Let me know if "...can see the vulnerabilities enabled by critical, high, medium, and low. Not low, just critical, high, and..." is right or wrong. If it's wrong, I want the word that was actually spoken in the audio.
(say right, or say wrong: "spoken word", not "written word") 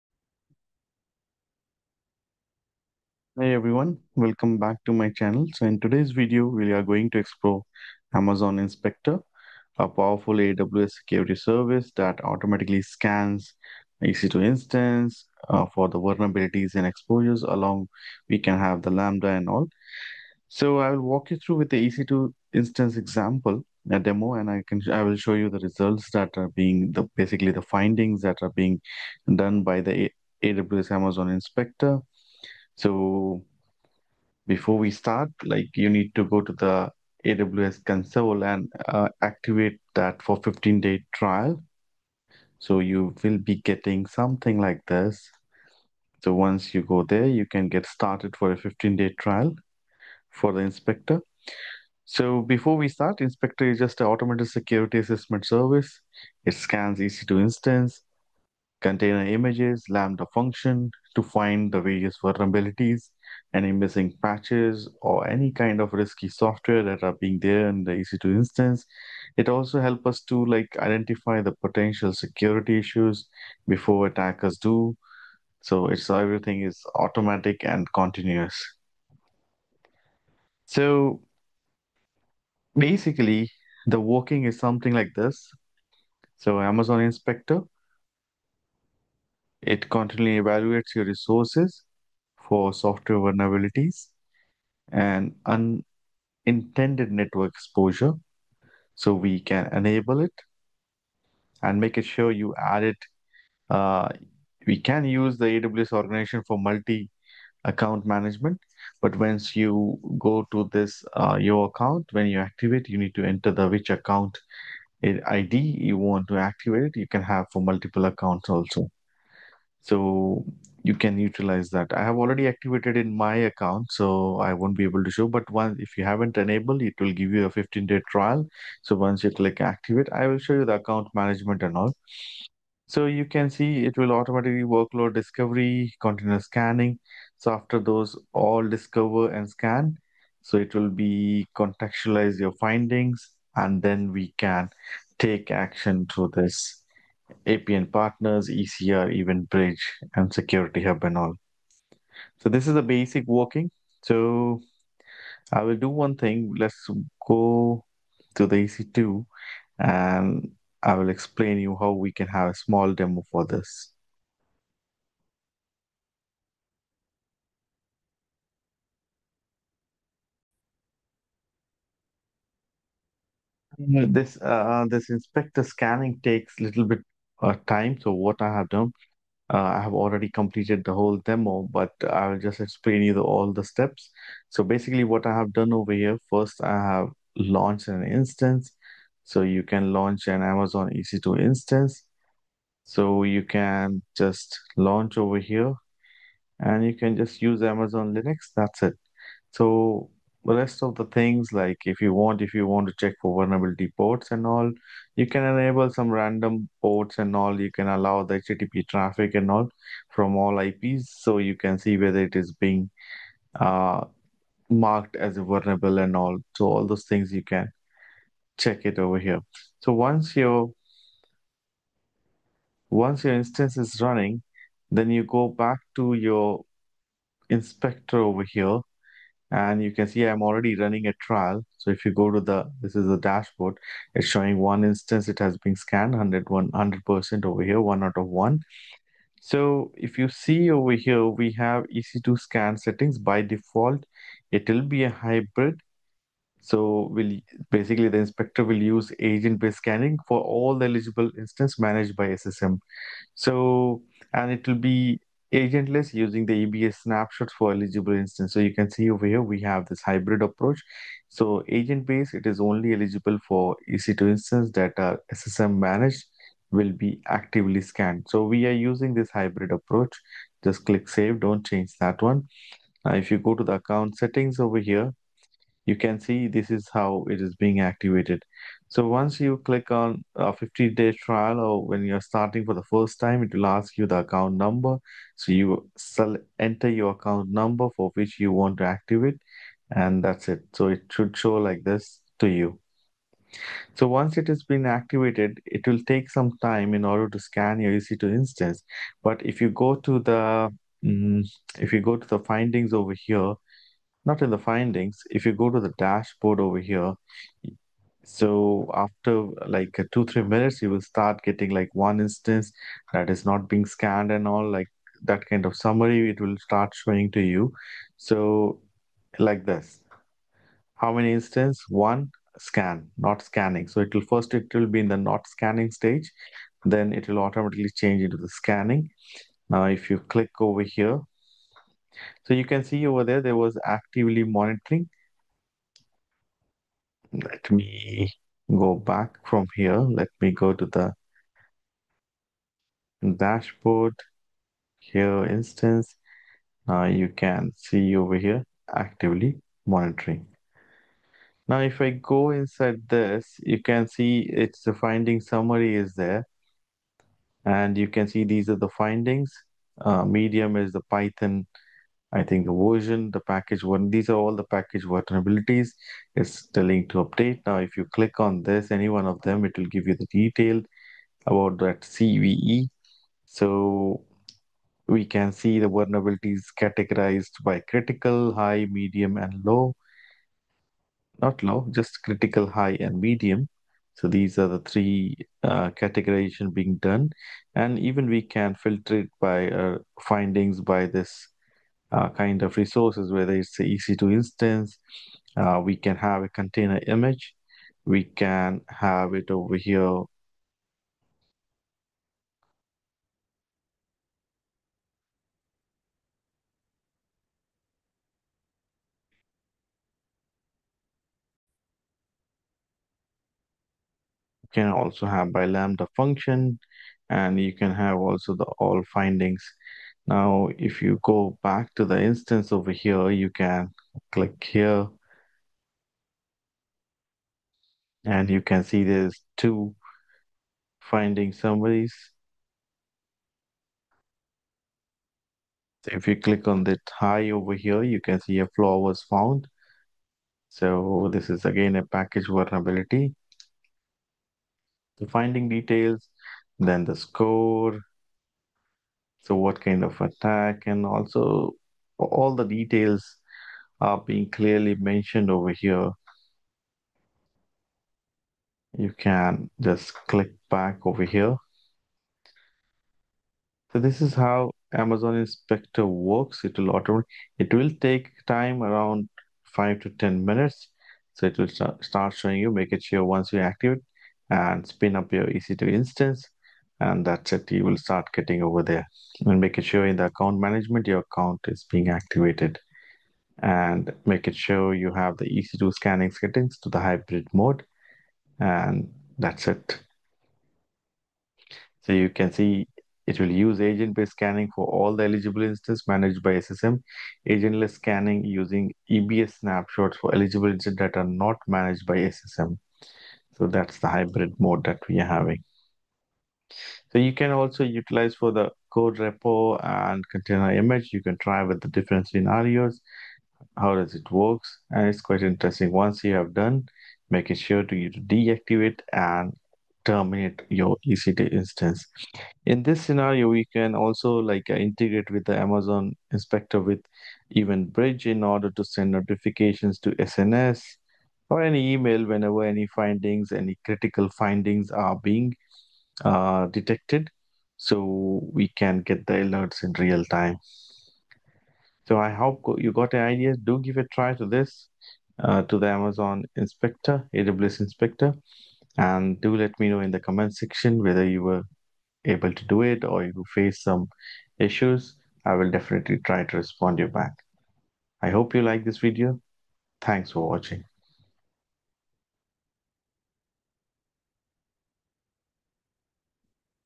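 wrong: "categorized", not "enabled".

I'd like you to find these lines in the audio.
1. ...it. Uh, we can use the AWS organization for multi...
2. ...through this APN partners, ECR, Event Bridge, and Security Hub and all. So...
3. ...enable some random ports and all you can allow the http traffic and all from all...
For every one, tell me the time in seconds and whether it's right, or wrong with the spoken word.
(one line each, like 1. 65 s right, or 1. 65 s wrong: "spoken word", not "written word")
1. 102 s right
2. 146 s right
3. 205 s right.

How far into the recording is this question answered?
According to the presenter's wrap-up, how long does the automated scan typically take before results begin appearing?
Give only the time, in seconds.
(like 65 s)
469 s.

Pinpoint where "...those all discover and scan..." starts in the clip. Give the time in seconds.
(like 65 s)
137 s.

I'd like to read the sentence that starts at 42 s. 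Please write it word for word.
So you will be getting something like this.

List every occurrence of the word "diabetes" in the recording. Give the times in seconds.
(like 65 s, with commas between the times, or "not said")
not said.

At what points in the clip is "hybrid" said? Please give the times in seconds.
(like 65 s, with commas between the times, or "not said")
245 s, 260 s, 269 s, 487 s, 504 s.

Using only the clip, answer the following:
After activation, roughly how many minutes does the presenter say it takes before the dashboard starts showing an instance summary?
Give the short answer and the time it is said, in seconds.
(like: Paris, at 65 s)
2-3 minutes, at 310 s.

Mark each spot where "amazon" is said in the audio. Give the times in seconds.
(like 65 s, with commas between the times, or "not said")
8 s, 30 s, 86 s, 190 s, 197 s, 464 s, 525 s, 545 s.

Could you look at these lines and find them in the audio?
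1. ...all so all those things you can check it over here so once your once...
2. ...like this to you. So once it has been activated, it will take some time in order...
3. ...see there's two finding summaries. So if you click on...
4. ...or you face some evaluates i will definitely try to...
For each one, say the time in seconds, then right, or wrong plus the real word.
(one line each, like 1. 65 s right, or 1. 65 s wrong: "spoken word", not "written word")
1. 216 s right
2. 291 s right
3. 428 s right
4. 553 s wrong: "issues", not "evaluates".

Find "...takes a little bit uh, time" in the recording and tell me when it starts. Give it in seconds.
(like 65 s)
176 s.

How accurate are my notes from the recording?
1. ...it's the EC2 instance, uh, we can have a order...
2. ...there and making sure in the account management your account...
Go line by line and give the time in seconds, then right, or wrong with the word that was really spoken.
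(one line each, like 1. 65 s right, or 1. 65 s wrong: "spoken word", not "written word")
1. 393 s wrong: "container", not "order"
2. 478 s right.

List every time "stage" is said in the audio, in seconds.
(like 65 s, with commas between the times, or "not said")
325 s.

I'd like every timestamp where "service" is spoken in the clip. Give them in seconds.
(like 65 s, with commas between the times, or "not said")
11 s, 55 s.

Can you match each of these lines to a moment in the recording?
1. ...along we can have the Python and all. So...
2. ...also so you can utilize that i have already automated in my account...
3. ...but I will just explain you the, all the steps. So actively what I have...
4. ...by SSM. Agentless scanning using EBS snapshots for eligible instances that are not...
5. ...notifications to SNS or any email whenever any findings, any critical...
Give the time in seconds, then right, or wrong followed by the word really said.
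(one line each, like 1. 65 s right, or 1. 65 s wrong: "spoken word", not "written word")
1. 17 s wrong: "Lambda", not "Python"
2. 118 s wrong: "activated", not "automated"
3. 181 s wrong: "basically", not "actively"
4. 496 s right
5. 529 s right.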